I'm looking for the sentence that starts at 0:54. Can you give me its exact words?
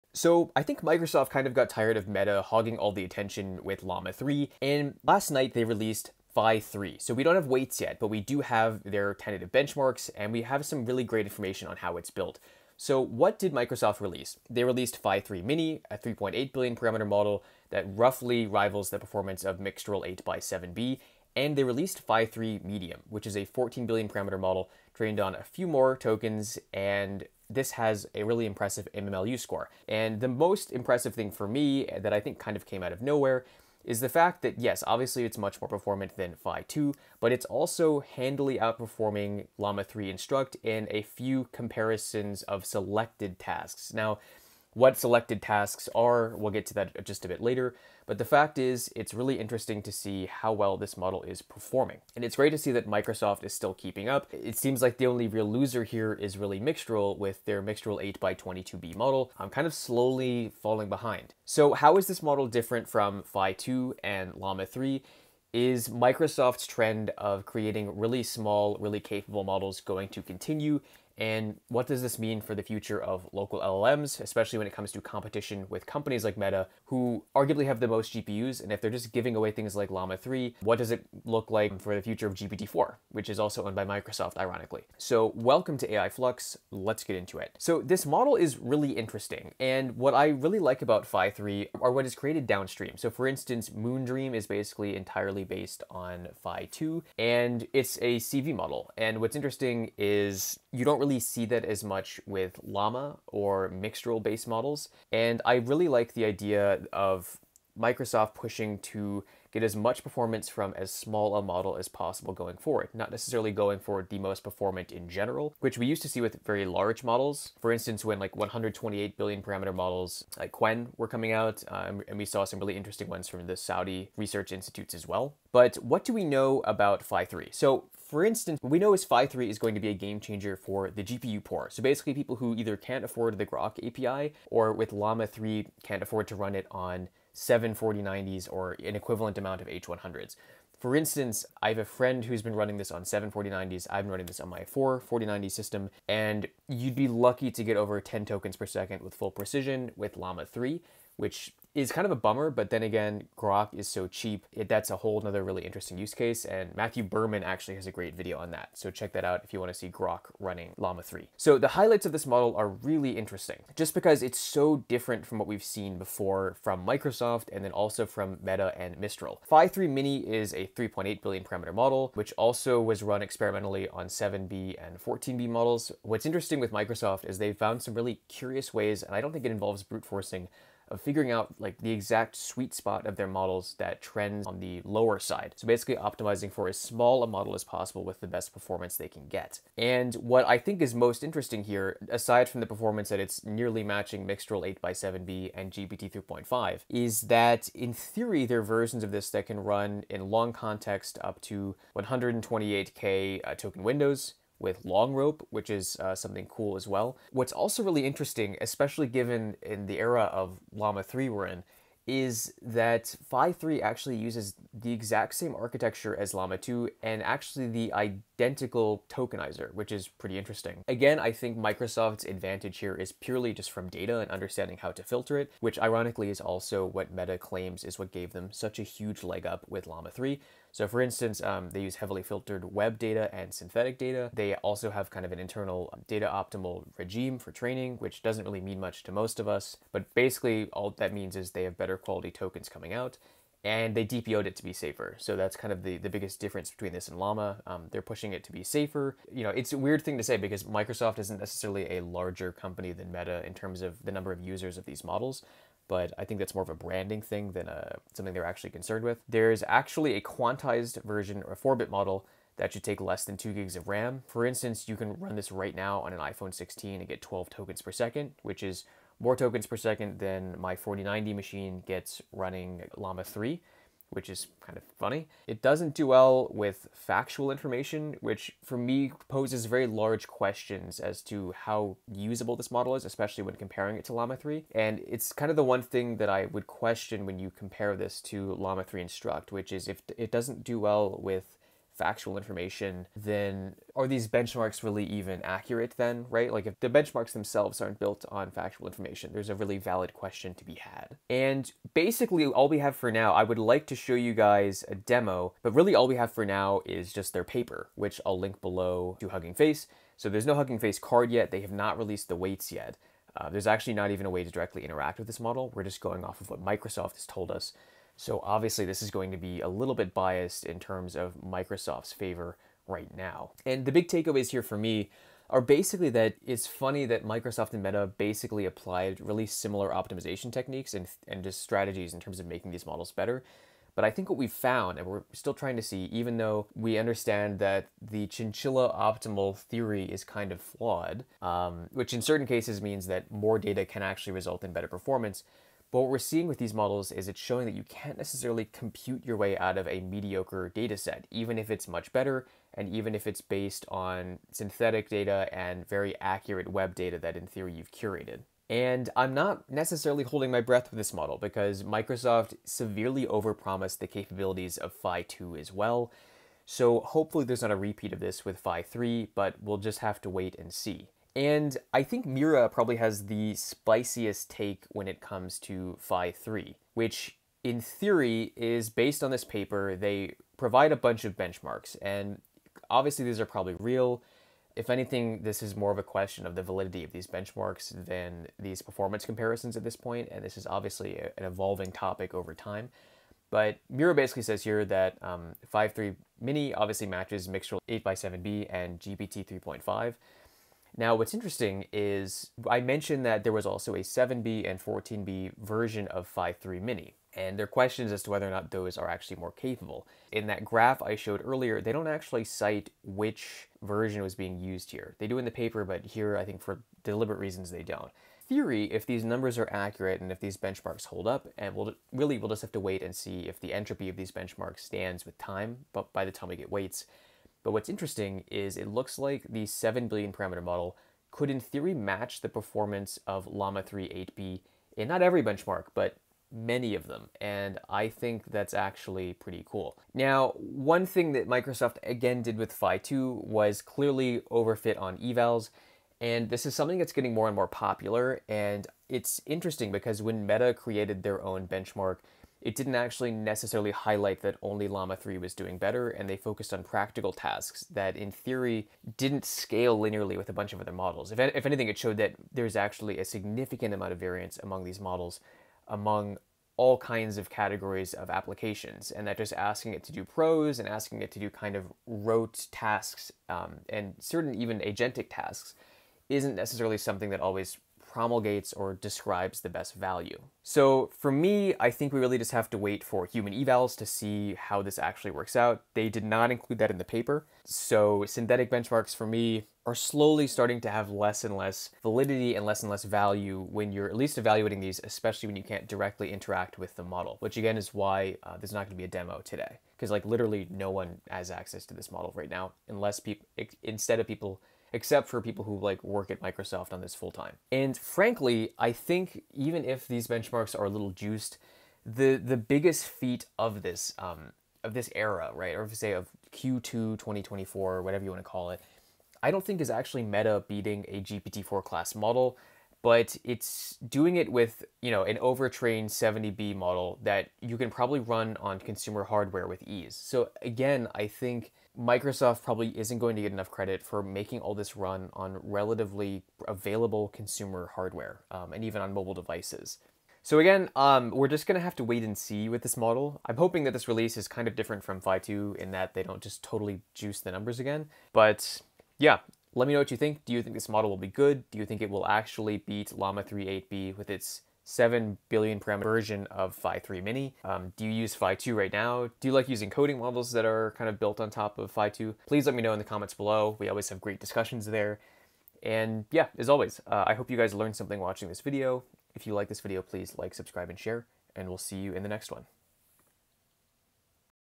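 It seems like the only real loser here is really Mixtral with their Mixtral 8x22b model.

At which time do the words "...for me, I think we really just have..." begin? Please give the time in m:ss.
8:01.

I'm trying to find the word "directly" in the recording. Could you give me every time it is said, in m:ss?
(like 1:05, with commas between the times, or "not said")
5:14, 8:15.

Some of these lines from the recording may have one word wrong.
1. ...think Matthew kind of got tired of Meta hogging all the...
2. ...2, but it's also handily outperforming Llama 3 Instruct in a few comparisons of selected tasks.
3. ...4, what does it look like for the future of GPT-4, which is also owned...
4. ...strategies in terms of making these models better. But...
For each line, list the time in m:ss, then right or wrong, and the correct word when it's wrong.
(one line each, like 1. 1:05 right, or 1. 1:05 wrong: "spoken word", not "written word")
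1. 0:00 wrong: "Microsoft", not "Matthew"
2. 0:36 right
3. 1:20 wrong: "3", not "4"
4. 5:31 right.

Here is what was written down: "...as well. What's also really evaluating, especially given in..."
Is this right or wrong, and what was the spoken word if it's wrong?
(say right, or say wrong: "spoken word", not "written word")
wrong: "interesting", not "evaluating".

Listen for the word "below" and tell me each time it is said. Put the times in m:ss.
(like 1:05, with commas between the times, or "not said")
5:08, 9:23.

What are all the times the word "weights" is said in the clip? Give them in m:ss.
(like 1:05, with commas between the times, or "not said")
0:07, 5:12, 7:06.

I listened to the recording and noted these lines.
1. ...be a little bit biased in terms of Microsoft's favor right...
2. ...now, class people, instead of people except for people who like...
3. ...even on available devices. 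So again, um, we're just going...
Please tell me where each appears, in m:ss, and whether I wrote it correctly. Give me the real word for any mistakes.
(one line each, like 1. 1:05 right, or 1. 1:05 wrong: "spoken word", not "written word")
1. 5:19 right
2. 8:22 wrong: "unless", not "class"
3. 8:58 wrong: "mobile", not "available".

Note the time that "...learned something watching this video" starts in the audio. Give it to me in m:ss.
9:27.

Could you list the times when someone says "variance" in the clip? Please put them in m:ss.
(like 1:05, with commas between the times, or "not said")
7:44.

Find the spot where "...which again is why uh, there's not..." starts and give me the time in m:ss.
8:17.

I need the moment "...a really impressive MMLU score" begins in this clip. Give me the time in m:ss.
0:28.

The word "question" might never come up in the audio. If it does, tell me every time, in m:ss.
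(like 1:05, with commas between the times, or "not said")
4:40, 4:46, 5:00, 6:26, 6:47.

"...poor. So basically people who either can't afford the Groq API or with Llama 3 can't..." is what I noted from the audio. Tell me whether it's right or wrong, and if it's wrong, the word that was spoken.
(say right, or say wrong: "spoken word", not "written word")
right.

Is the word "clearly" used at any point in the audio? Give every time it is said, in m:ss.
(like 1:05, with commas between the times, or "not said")
7:23.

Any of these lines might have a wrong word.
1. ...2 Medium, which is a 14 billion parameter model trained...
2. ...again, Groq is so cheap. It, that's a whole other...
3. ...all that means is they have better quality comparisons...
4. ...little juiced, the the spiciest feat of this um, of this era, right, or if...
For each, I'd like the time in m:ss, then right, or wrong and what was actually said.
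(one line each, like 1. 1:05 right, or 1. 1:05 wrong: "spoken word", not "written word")
1. 0:22 wrong: "3", not "2"
2. 2:32 right
3. 4:00 wrong: "tokens", not "comparisons"
4. 8:30 wrong: "biggest", not "spiciest".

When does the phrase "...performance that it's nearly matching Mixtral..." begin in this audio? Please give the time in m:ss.
3:12.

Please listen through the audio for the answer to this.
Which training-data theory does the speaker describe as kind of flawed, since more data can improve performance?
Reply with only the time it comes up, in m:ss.
5:38.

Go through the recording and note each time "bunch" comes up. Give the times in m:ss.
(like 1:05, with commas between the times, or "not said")
6:20, 7:40.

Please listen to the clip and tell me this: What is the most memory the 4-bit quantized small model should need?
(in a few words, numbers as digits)
2 gigs.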